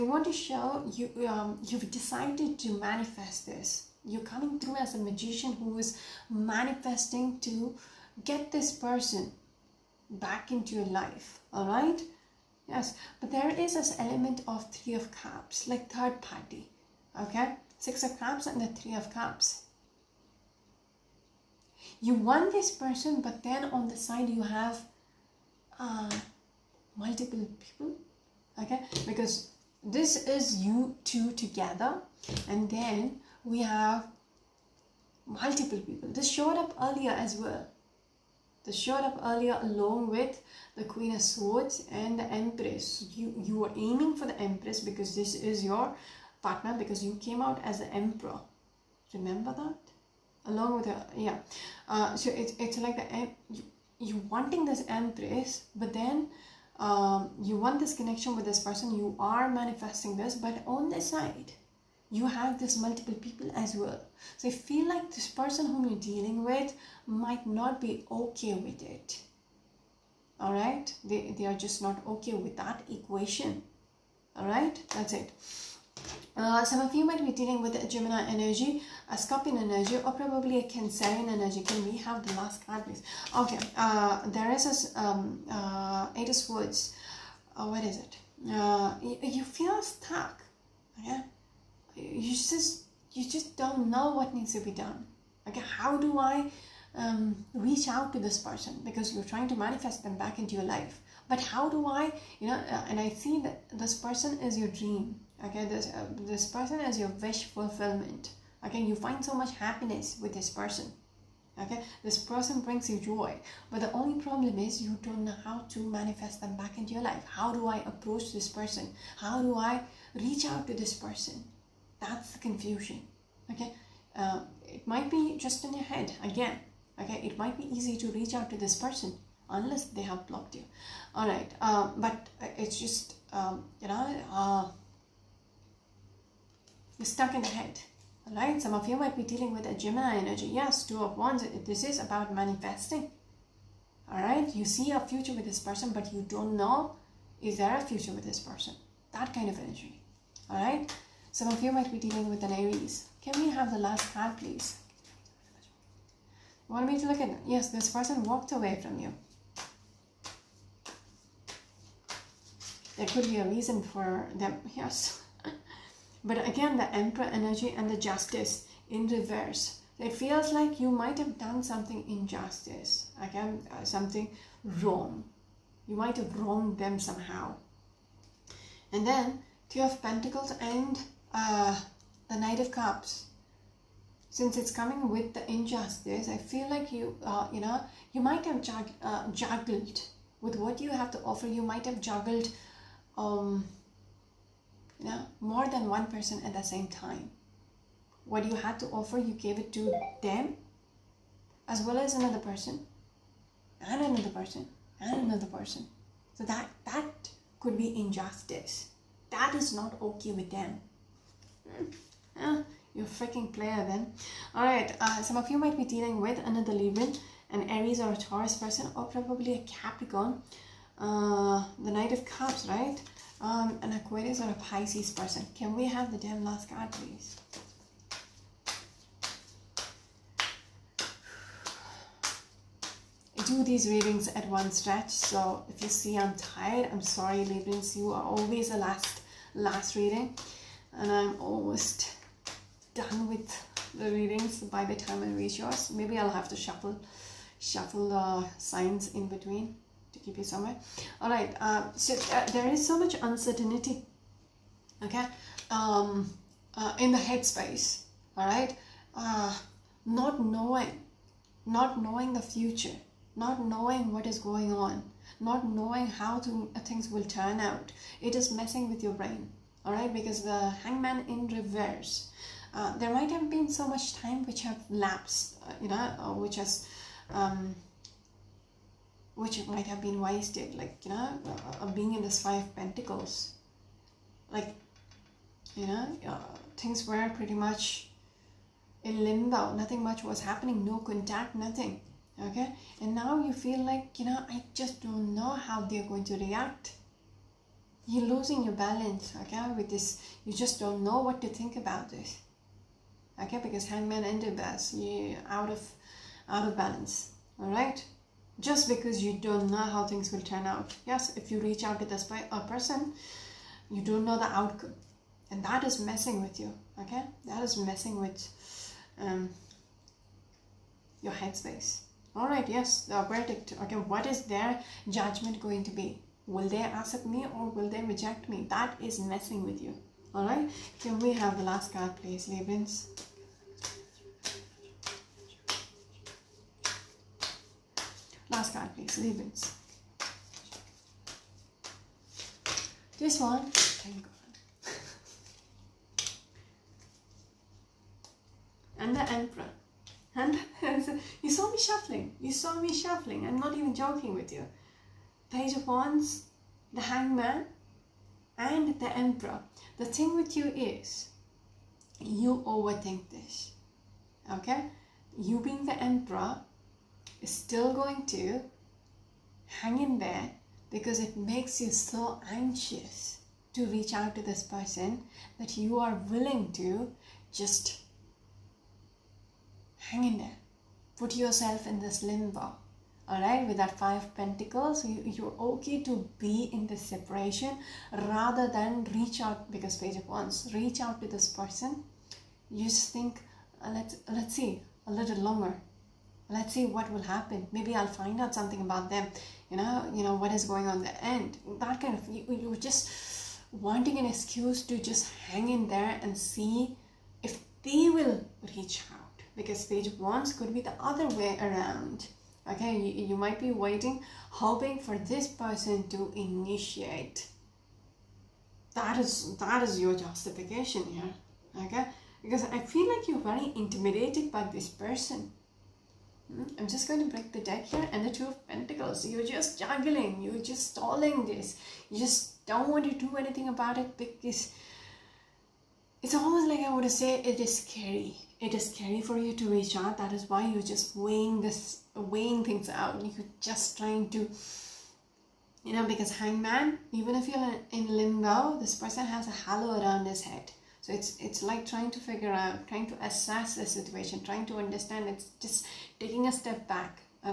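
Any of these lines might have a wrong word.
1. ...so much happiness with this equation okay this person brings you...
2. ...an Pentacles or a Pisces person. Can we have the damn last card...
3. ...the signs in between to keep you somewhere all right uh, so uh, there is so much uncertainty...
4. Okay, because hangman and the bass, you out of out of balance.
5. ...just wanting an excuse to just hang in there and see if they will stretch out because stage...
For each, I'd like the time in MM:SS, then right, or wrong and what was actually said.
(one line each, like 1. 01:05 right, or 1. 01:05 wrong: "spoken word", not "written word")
1. 01:49 wrong: "person", not "equation"
2. 03:43 wrong: "Aquarius", not "Pentacles"
3. 04:08 right
4. 05:03 right
5. 06:42 wrong: "reach", not "stretch".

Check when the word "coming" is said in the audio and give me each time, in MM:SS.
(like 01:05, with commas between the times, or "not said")
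00:04, 03:04.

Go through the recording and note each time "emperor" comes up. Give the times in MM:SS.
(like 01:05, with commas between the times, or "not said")
00:48, 02:46, 05:49, 05:59, 06:06.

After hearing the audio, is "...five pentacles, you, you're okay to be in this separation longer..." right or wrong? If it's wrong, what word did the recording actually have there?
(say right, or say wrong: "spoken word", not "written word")
wrong: "rather", not "longer".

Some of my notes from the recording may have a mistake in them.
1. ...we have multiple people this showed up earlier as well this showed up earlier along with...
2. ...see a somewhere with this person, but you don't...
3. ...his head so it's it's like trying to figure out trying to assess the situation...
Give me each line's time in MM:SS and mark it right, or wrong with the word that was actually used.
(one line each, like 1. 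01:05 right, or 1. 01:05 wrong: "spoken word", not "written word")
1. 00:33 right
2. 02:24 wrong: "future", not "somewhere"
3. 07:30 right.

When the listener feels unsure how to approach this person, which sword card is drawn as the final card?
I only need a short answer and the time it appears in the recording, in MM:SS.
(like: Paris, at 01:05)
Eight of Swords, at 01:26.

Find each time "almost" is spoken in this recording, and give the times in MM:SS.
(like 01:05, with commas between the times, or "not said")
04:01, 07:16.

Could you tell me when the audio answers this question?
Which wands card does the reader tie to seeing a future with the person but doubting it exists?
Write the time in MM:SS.
02:20.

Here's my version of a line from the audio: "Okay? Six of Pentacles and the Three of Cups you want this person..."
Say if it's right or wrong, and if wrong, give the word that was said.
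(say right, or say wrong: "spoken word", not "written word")
wrong: "Cups", not "Pentacles".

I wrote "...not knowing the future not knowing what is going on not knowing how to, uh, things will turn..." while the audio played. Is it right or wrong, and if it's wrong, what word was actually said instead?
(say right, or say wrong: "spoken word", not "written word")
right.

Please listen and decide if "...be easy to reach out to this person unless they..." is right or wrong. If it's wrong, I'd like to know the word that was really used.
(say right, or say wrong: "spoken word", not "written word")
right.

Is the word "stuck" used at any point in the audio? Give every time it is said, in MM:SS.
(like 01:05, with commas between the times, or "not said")
01:29, 02:17.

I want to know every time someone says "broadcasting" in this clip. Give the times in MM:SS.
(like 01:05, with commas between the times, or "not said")
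not said.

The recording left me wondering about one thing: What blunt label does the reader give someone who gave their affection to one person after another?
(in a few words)
a freaking player.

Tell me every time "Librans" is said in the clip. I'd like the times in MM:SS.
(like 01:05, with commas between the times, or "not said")
03:36, 03:57, 05:32.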